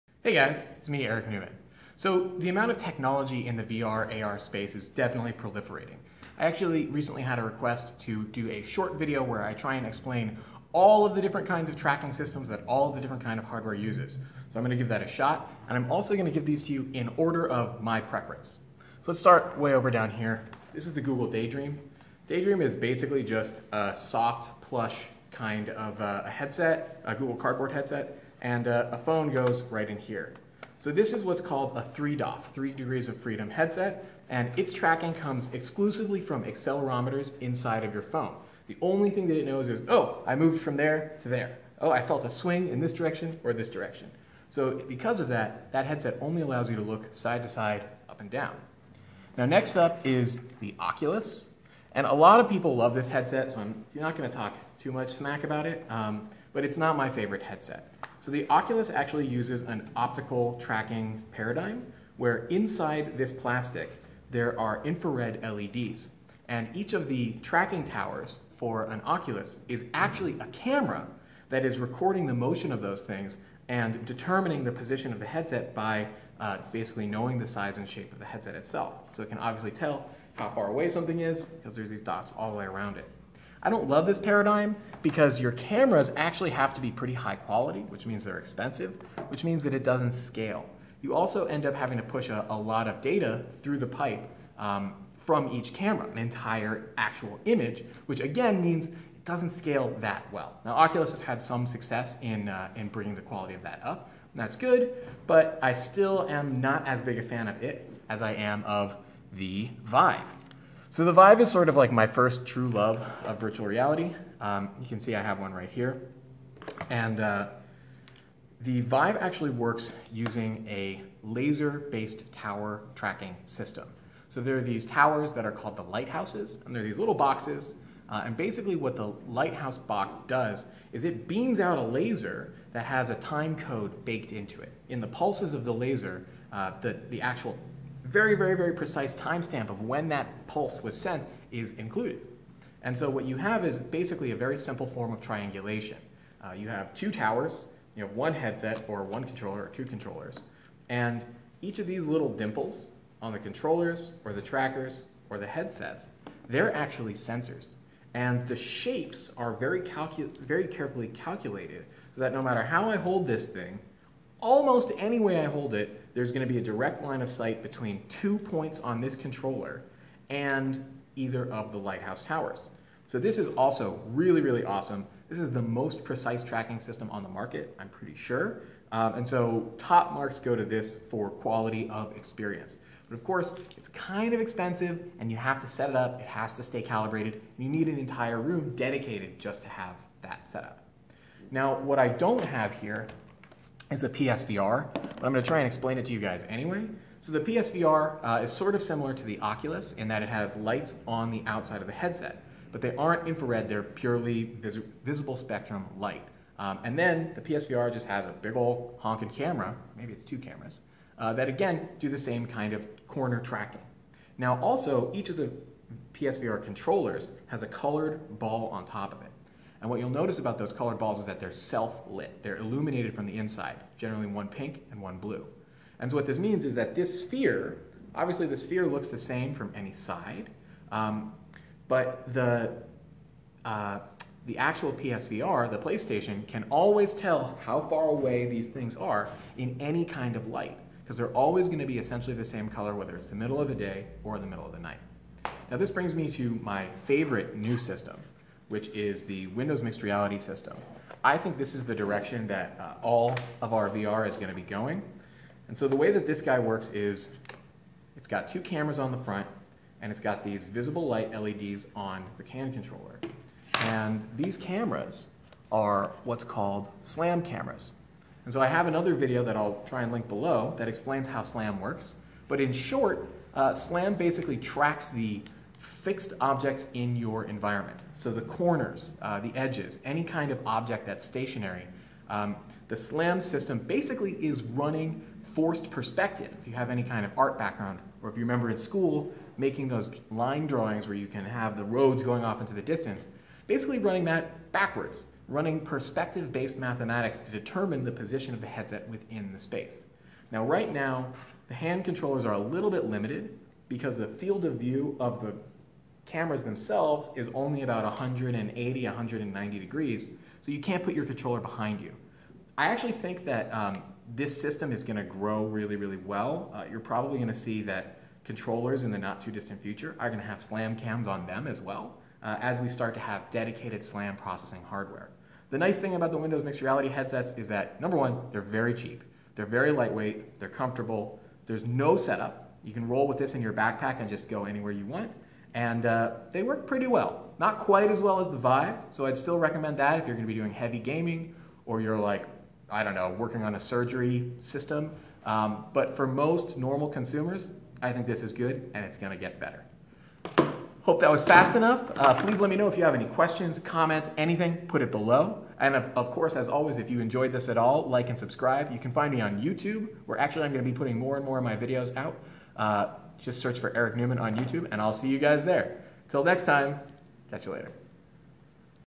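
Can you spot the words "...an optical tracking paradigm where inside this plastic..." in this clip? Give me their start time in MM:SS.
00:59.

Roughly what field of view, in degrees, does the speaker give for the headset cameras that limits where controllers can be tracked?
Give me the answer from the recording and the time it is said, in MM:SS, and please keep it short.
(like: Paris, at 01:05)
About 180 to 190 degrees, at 05:08.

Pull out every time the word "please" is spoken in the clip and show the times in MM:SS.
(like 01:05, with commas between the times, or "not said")
05:52.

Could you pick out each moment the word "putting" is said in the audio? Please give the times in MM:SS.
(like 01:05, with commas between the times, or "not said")
06:00.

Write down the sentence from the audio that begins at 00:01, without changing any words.
So the amount of technology in the VR AR space is definitely proliferating.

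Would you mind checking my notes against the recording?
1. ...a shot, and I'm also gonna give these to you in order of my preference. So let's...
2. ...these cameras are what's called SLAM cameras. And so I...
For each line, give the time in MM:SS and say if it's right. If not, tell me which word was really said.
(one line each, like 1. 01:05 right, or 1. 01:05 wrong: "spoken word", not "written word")
1. 00:15 right
2. 04:24 right.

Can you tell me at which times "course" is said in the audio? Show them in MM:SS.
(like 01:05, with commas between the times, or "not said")
03:03, 05:56.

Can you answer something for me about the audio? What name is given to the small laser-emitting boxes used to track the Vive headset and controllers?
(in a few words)
Lighthouses.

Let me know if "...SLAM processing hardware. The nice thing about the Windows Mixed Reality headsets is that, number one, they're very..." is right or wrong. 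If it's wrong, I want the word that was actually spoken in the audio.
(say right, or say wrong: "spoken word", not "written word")
right.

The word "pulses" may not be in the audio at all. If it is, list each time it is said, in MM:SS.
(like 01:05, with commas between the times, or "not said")
02:15, 02:20.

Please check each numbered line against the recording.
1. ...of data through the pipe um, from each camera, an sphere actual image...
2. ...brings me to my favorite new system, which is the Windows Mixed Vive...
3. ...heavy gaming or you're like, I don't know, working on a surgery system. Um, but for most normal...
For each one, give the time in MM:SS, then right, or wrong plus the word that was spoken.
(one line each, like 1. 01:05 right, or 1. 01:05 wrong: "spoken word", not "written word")
1. 01:32 wrong: "entire", not "sphere"
2. 04:05 wrong: "Reality", not "Vive"
3. 05:40 right.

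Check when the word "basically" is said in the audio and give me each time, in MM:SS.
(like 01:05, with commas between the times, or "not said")
00:22, 01:16, 02:08, 02:23, 04:34, 04:43, 04:53.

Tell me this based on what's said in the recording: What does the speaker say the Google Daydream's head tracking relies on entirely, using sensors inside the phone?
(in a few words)
Accelerometers.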